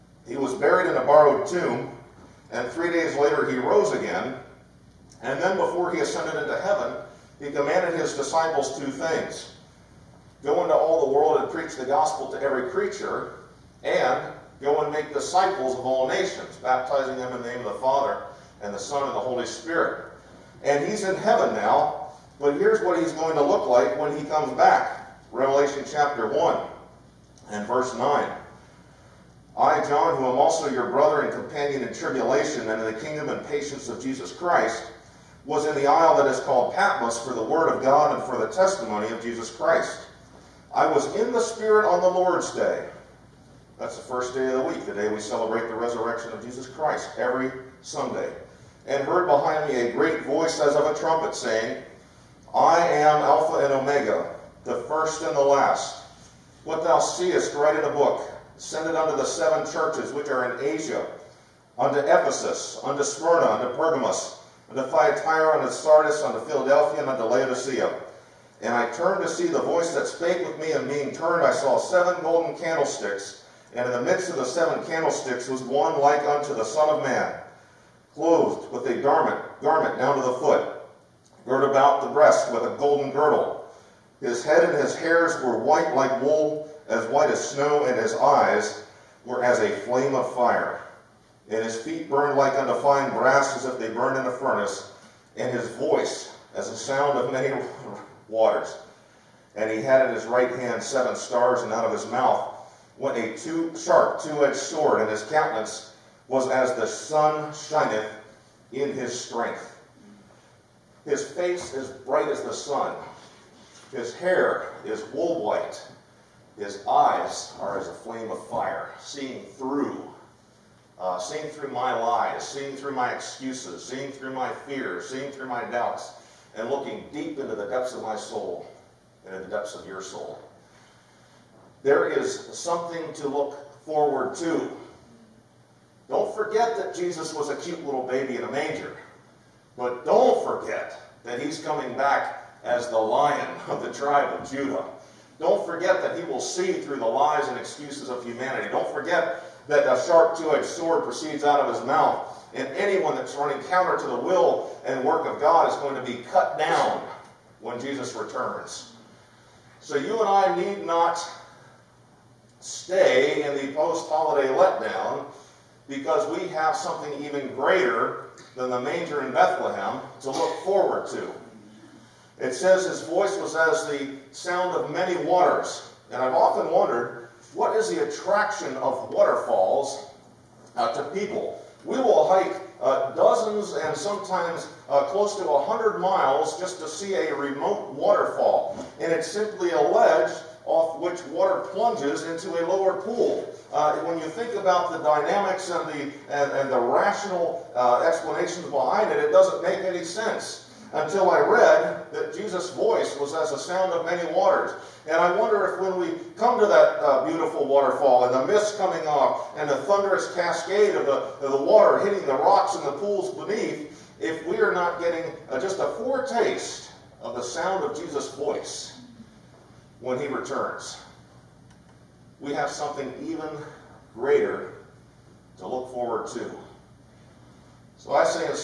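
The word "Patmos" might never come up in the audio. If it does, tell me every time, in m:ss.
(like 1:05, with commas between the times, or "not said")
0:36.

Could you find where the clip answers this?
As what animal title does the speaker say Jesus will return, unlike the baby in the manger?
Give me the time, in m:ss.
2:22.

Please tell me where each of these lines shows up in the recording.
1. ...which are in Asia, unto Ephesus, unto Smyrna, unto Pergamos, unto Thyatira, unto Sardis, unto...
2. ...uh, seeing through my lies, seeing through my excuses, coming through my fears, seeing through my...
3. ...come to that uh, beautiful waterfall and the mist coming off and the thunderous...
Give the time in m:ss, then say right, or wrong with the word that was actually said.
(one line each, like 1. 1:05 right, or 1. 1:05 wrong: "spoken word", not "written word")
1. 1:00 right
2. 2:00 wrong: "seeing", not "coming"
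3. 3:26 right.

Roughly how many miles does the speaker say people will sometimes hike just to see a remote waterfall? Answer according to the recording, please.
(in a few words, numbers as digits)
100.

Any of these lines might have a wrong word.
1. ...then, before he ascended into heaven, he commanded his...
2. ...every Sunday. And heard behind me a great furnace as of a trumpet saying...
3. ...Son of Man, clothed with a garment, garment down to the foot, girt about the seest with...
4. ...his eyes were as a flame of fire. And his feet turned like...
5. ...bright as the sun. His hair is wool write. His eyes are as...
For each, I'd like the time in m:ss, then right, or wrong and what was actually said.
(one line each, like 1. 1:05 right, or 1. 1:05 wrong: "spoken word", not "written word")
1. 0:05 right
2. 0:47 wrong: "voice", not "furnace"
3. 1:16 wrong: "breast", not "seest"
4. 1:27 wrong: "burned", not "turned"
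5. 1:52 wrong: "white", not "write".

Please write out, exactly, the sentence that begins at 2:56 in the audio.
And I've often wondered, what is the attraction of waterfalls uh, to people?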